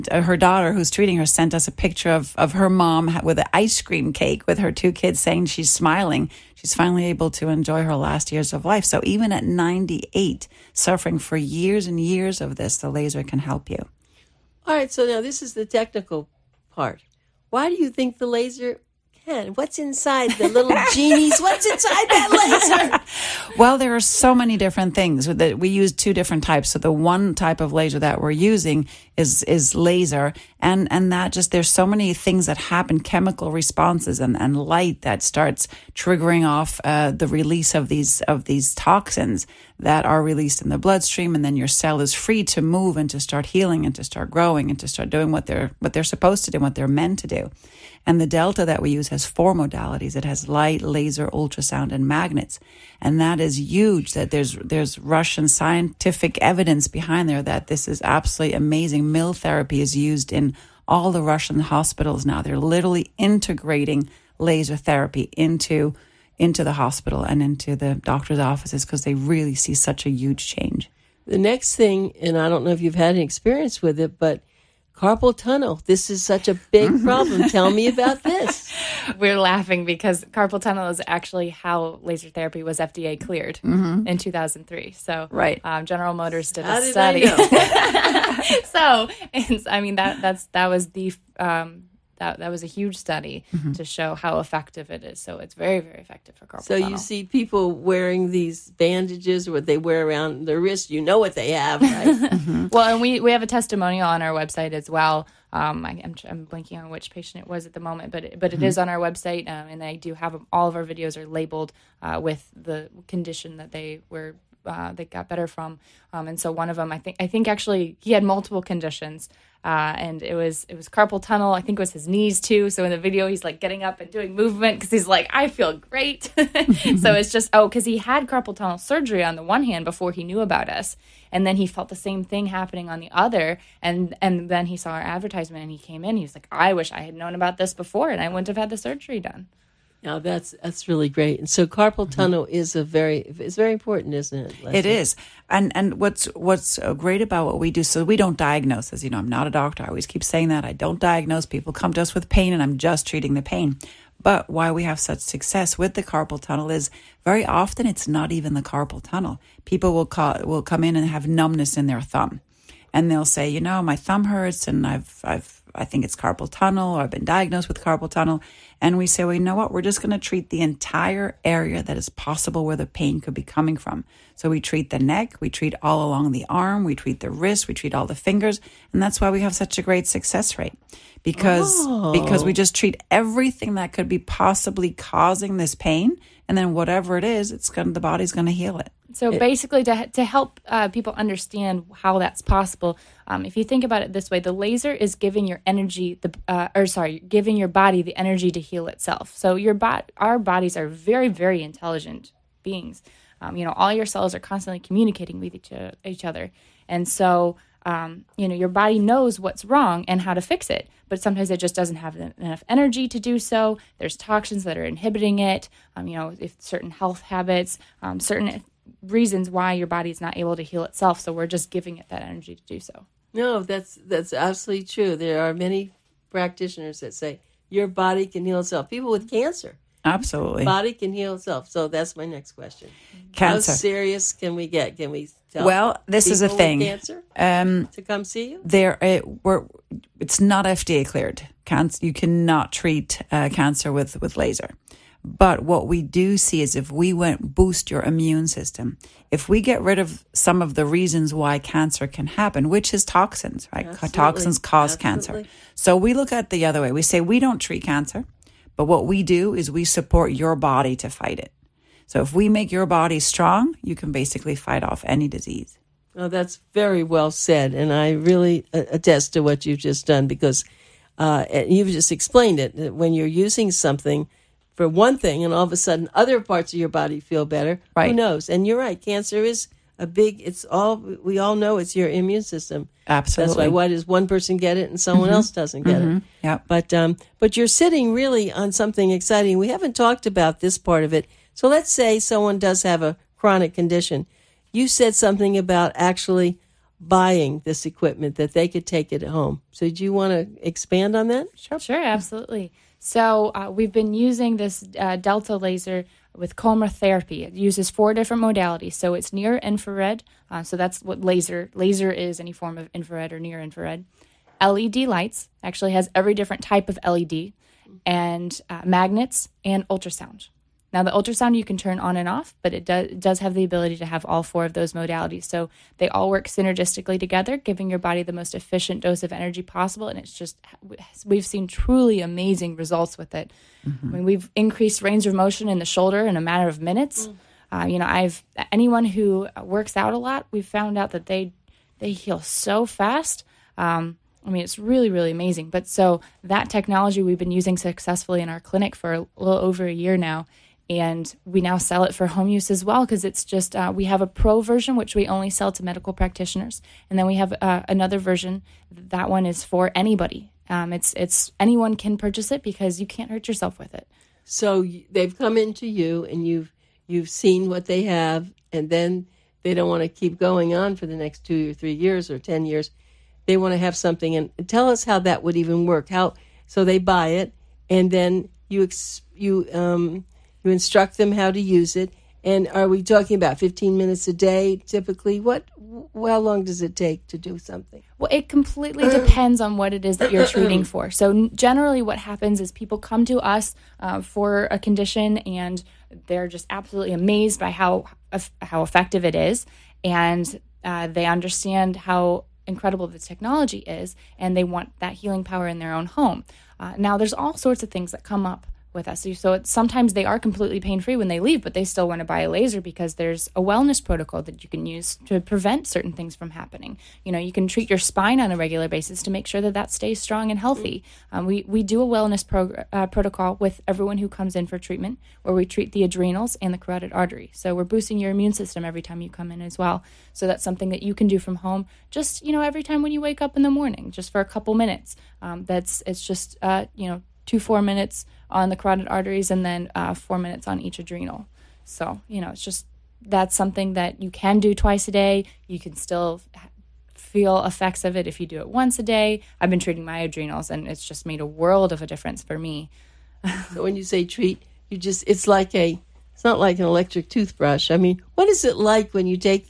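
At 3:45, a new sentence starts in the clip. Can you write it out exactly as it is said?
There are many practitioners that say your body can heal itself.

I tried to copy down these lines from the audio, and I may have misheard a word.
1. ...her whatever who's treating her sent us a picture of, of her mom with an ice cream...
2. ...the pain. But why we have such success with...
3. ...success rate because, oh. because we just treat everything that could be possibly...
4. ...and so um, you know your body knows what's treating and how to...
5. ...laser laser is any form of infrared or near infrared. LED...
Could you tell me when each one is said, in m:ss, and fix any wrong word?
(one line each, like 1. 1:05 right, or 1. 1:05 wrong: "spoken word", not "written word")
1. 0:00 wrong: "daughter", not "whatever"
2. 2:33 right
3. 3:00 right
4. 3:26 wrong: "wrong", not "treating"
5. 5:11 right.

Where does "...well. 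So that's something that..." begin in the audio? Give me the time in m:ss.
7:09.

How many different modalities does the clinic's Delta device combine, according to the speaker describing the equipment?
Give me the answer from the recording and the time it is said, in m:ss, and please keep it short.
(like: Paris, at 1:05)
4, at 0:49.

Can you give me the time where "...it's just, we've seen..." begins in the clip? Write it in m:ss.
5:30.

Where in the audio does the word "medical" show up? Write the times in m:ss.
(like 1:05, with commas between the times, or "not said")
5:55.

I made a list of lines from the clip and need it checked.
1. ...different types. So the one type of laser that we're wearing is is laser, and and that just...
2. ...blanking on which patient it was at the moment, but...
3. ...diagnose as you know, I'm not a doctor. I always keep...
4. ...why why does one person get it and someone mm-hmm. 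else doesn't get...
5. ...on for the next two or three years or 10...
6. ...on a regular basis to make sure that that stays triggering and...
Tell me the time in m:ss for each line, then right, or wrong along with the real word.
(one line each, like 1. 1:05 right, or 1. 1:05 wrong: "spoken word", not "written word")
1. 0:26 wrong: "using", not "wearing"
2. 1:46 right
3. 2:28 right
4. 4:43 right
5. 6:10 right
6. 6:58 wrong: "strong", not "triggering".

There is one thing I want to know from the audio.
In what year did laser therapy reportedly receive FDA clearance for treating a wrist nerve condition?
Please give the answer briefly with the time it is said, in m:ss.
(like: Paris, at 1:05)
2003, at 1:24.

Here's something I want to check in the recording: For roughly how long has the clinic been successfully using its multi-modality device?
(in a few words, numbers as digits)
A little over a year.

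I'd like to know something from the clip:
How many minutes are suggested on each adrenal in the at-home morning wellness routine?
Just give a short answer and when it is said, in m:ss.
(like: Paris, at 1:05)
4, at 7:20.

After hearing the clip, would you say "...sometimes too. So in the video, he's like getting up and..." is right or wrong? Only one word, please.
wrong.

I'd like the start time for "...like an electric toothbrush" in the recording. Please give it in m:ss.
7:36.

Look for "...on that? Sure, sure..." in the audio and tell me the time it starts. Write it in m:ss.
5:01.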